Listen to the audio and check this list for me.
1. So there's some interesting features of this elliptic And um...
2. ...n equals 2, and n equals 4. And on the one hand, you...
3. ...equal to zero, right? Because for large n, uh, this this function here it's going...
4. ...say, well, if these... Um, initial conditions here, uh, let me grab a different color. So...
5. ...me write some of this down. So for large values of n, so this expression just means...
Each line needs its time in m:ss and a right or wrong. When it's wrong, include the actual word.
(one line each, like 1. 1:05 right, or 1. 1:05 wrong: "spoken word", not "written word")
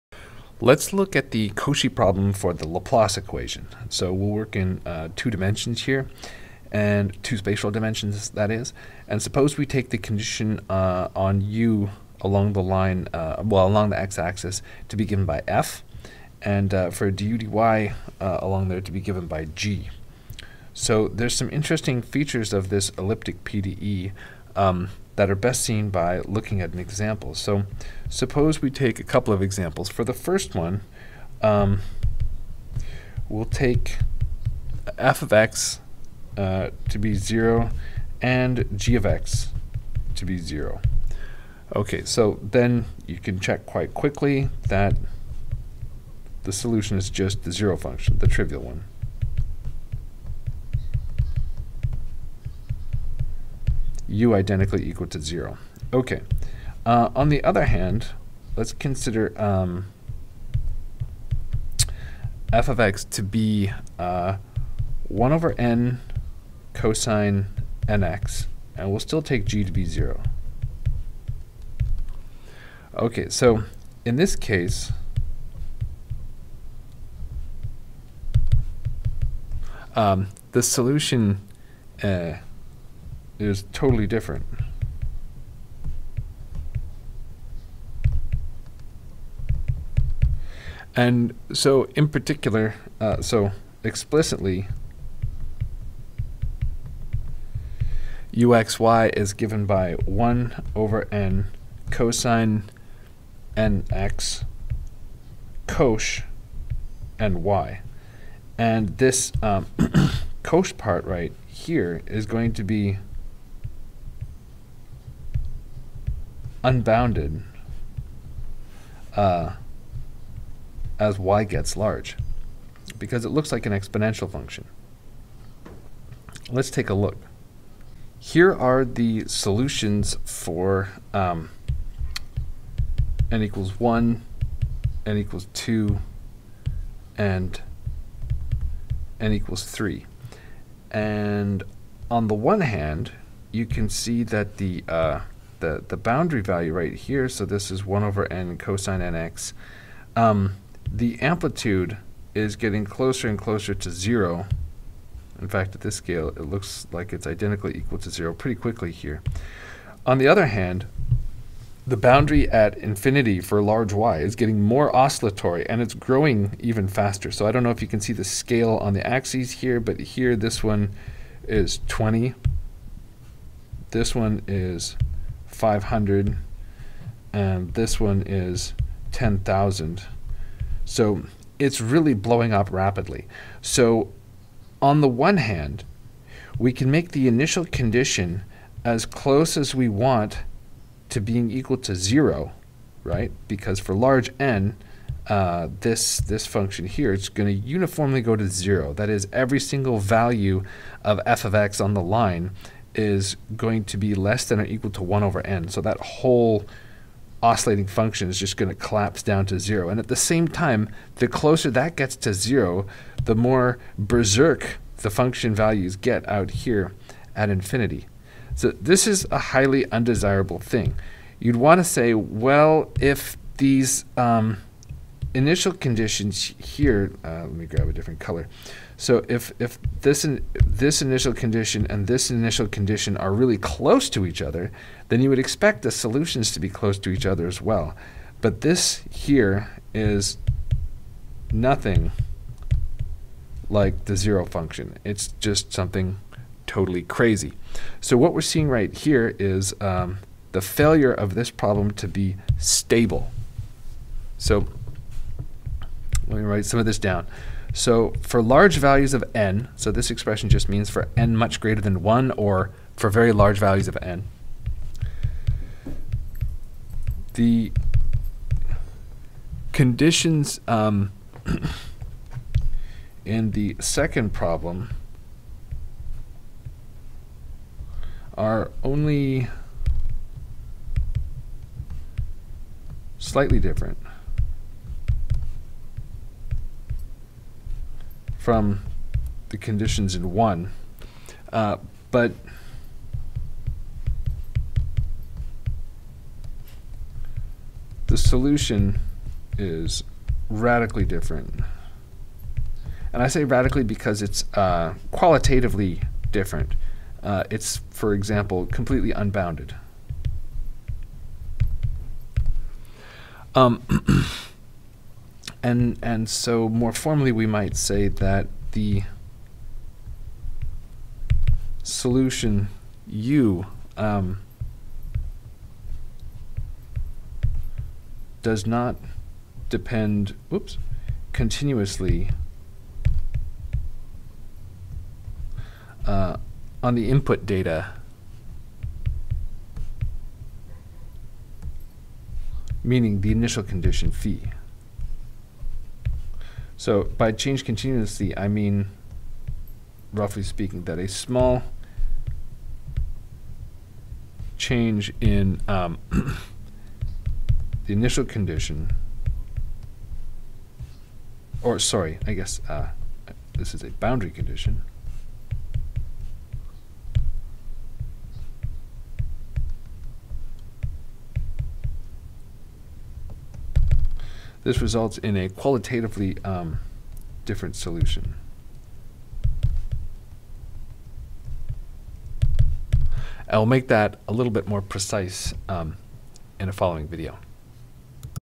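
1. 0:20 wrong: "PDE", not "And"
2. 2:15 wrong: "3", not "4"
3. 3:11 right
4. 3:41 right
5. 4:16 right.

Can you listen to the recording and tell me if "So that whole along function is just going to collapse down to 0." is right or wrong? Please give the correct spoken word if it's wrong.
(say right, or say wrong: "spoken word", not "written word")
wrong: "oscillating", not "along".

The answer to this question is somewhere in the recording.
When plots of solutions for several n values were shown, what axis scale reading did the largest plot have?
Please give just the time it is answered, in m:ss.
2:59.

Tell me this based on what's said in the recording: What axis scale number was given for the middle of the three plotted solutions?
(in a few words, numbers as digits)
500.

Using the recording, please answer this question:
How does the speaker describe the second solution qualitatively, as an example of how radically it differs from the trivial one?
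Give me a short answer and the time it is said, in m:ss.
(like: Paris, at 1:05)
completely unbounded, at 5:08.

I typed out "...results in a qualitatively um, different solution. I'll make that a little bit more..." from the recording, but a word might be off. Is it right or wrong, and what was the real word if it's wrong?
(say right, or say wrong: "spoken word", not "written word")
right.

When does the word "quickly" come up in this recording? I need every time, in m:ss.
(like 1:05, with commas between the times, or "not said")
0:43, 2:38.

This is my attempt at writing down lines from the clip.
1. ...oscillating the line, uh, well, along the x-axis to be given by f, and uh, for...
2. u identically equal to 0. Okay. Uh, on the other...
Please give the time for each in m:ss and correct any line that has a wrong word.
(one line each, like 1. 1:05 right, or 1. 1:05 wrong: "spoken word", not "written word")
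1. 0:12 wrong: "along", not "oscillating"
2. 0:54 right.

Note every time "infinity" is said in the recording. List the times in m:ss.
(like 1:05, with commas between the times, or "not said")
2:42, 3:37.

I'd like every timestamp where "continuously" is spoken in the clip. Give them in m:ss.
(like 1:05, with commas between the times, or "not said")
5:31, 5:47.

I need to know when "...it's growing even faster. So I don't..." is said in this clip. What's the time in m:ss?
2:45.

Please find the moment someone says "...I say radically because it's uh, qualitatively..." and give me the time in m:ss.
5:03.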